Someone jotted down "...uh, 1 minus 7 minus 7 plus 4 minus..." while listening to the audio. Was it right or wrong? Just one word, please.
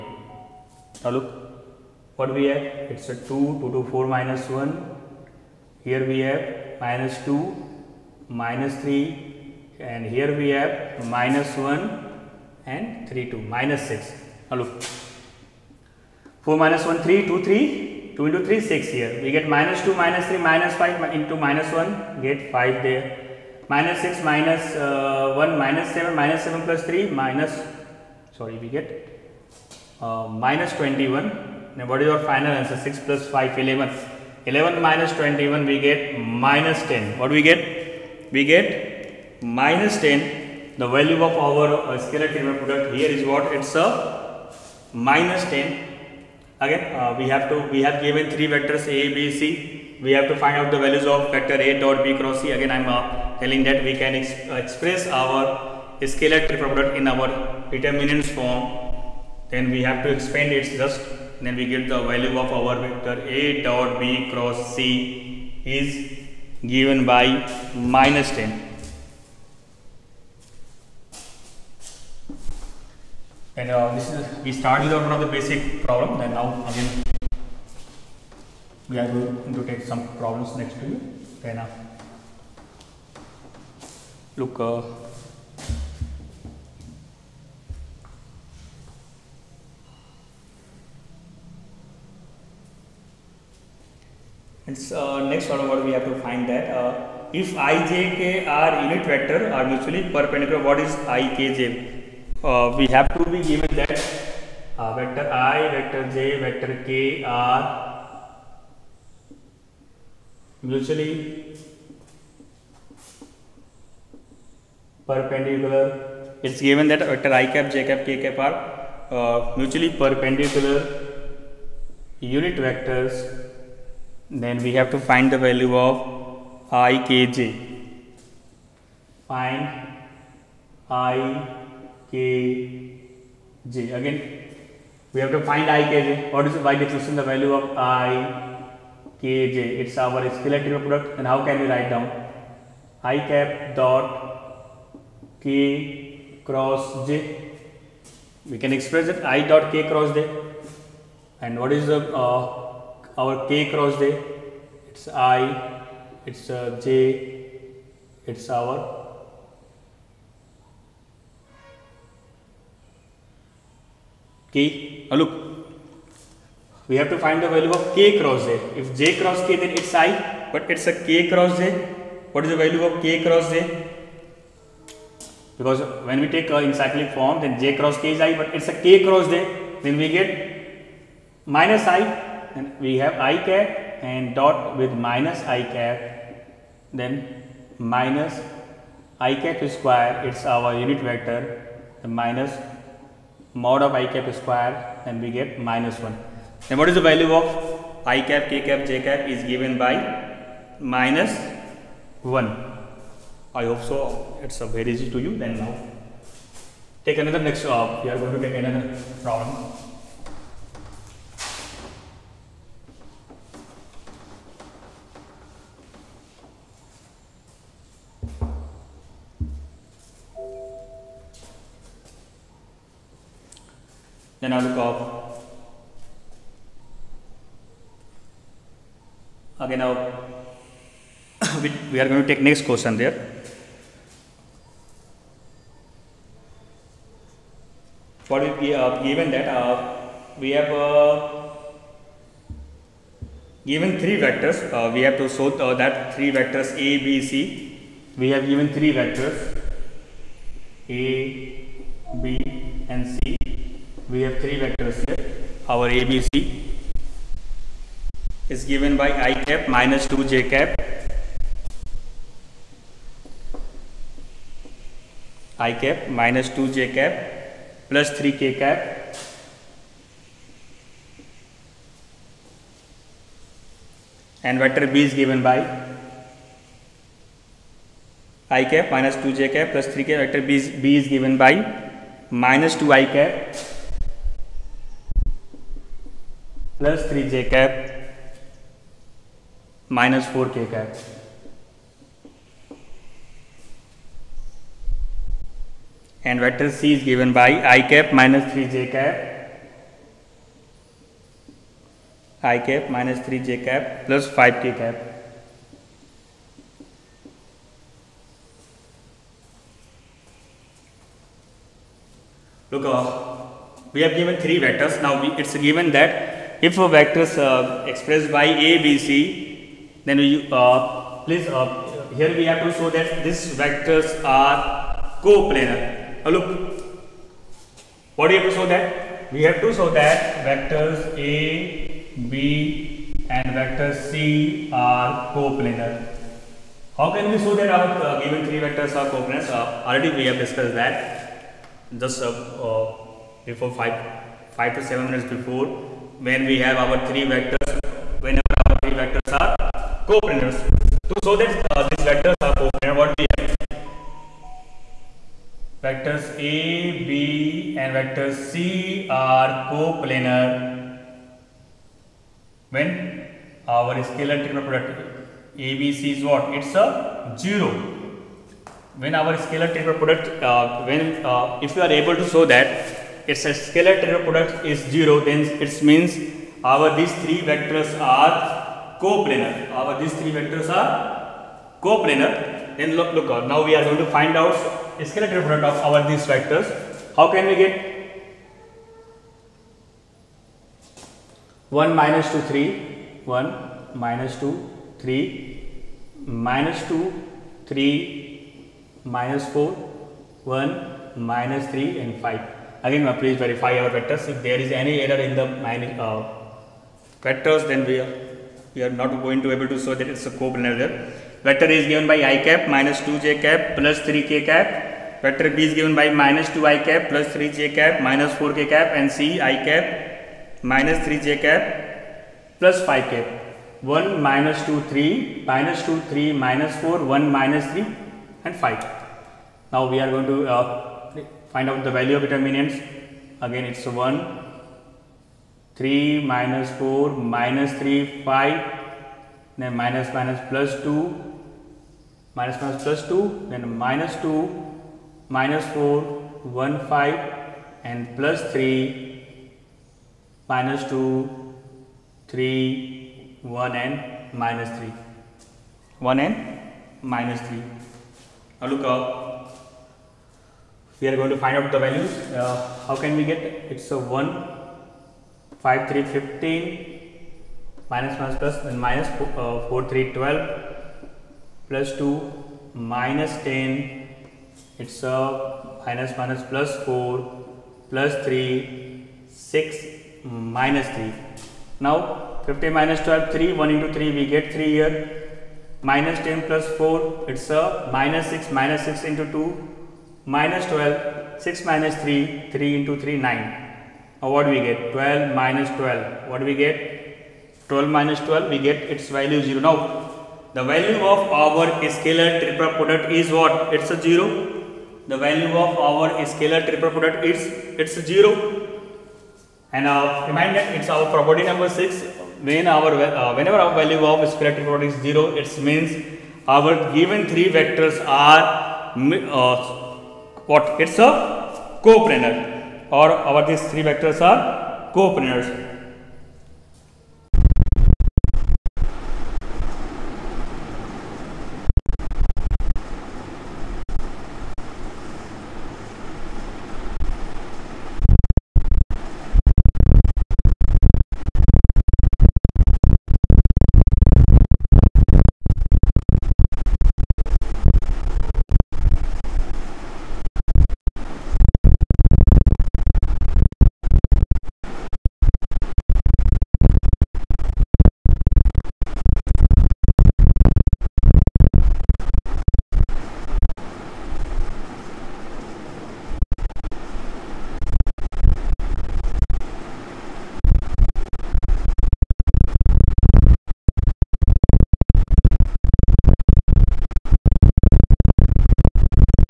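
wrong.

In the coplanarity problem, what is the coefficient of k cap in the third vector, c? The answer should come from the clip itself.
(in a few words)
5.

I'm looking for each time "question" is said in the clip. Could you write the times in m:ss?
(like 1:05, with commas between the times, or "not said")
3:52.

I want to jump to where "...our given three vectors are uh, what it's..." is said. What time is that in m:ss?
8:36.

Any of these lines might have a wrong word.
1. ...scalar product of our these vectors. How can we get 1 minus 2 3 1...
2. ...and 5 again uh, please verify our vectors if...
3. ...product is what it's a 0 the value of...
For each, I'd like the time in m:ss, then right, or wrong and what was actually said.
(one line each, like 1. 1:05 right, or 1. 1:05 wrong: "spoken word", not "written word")
1. 6:25 right
2. 6:42 right
3. 8:22 right.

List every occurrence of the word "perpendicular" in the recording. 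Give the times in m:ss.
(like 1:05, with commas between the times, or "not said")
1:40, 1:55, 1:59.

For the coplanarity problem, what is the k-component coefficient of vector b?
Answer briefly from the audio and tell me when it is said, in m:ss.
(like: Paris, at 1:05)
-4, at 4:49.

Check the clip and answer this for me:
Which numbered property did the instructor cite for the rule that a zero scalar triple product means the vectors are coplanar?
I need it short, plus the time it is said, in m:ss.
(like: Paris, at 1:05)
6, at 8:31.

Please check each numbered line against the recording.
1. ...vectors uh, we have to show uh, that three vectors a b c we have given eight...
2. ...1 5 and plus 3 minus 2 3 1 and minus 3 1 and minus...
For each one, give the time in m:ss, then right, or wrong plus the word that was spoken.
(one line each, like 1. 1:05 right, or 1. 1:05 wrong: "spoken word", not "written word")
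1. 4:04 wrong: "three", not "eight"
2. 7:26 right.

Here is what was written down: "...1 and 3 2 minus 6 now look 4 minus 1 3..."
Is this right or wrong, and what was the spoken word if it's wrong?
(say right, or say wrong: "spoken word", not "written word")
right.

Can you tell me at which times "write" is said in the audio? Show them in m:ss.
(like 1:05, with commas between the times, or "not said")
2:21.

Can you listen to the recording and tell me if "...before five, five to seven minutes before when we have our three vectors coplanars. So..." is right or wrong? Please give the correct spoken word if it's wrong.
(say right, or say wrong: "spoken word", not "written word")
right.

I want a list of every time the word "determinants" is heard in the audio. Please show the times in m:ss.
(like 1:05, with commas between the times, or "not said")
0:57, 7:12.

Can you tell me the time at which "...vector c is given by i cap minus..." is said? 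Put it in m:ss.
4:56.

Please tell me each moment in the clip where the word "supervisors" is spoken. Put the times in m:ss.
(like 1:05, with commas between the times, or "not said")
not said.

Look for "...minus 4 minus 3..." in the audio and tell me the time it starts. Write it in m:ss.
7:16.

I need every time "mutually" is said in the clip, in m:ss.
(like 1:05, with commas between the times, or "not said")
1:39, 1:50, 1:59.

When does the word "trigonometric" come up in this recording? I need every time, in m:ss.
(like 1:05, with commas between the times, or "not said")
6:04, 6:09, 6:14.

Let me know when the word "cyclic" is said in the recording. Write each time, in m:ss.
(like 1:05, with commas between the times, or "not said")
2:56.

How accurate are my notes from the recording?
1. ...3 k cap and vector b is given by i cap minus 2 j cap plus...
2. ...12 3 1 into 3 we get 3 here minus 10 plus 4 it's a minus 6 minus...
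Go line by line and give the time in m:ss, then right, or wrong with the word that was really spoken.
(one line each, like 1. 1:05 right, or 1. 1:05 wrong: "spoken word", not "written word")
1. 4:28 right
2. 8:03 right.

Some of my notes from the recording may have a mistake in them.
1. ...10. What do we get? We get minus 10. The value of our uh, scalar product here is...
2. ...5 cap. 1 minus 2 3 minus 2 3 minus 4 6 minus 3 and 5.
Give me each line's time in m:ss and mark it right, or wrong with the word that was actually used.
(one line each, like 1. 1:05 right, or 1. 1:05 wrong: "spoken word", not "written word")
1. 0:36 right
2. 7:02 wrong: "1", not "6".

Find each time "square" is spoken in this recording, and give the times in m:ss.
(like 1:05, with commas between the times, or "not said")
3:09, 3:14.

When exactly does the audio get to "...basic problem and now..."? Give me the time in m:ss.
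1:15.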